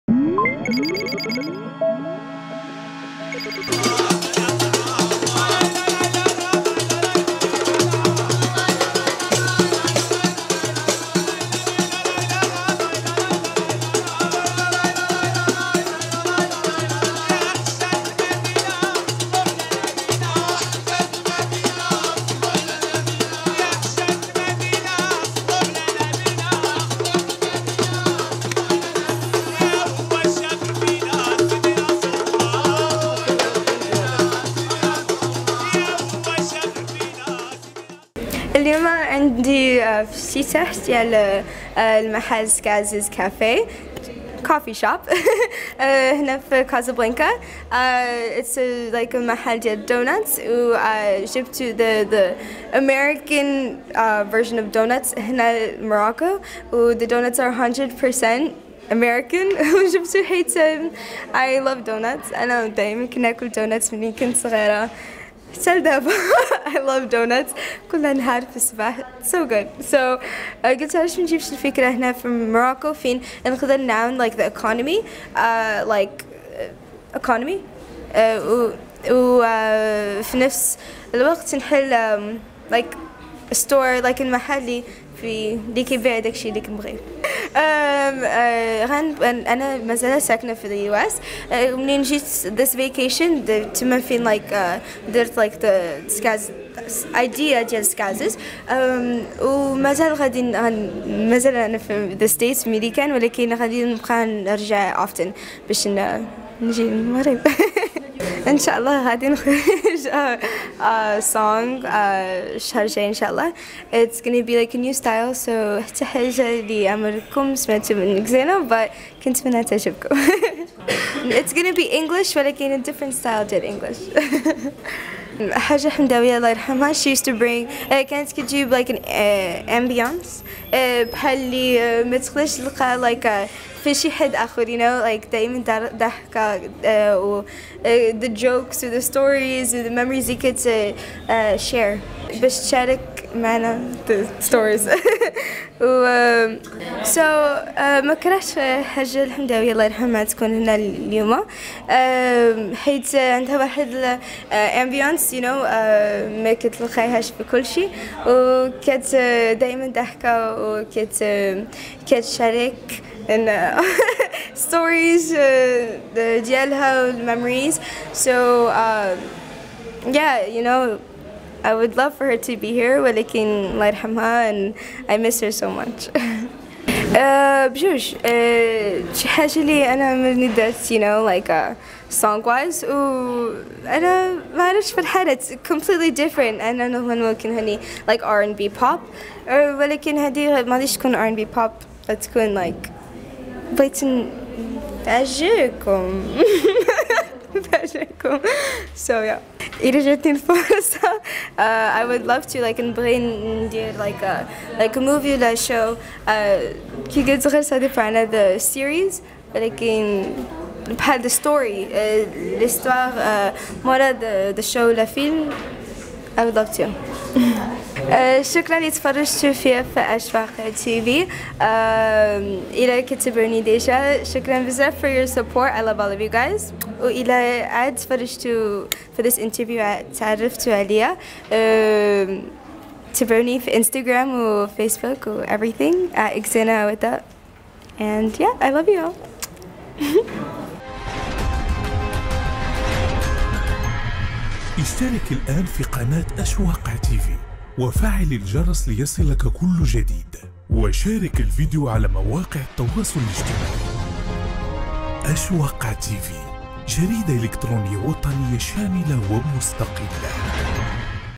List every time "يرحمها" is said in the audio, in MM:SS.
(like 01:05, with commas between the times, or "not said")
02:06, 02:29, 02:53.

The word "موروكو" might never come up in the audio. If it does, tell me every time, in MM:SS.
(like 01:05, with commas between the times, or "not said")
01:12.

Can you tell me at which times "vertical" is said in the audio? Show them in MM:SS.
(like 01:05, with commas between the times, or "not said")
not said.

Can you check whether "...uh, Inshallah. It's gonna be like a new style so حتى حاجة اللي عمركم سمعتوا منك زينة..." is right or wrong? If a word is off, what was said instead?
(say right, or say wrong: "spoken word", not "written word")
right.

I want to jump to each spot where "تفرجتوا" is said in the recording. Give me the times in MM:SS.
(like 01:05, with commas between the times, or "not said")
03:38, 03:47.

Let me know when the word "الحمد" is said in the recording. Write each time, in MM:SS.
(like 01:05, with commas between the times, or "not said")
02:29.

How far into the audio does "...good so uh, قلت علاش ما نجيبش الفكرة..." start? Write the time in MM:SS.
01:09.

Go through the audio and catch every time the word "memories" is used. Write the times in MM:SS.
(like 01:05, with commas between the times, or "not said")
02:19, 02:47.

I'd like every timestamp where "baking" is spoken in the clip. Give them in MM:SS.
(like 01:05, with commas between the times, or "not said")
not said.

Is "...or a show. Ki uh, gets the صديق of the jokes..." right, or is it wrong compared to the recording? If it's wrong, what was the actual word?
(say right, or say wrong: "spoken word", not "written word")
wrong: "series", not "jokes".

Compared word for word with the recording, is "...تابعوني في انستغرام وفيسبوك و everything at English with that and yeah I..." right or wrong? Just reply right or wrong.
wrong.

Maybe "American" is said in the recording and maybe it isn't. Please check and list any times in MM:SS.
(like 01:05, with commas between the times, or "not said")
00:52, 00:58.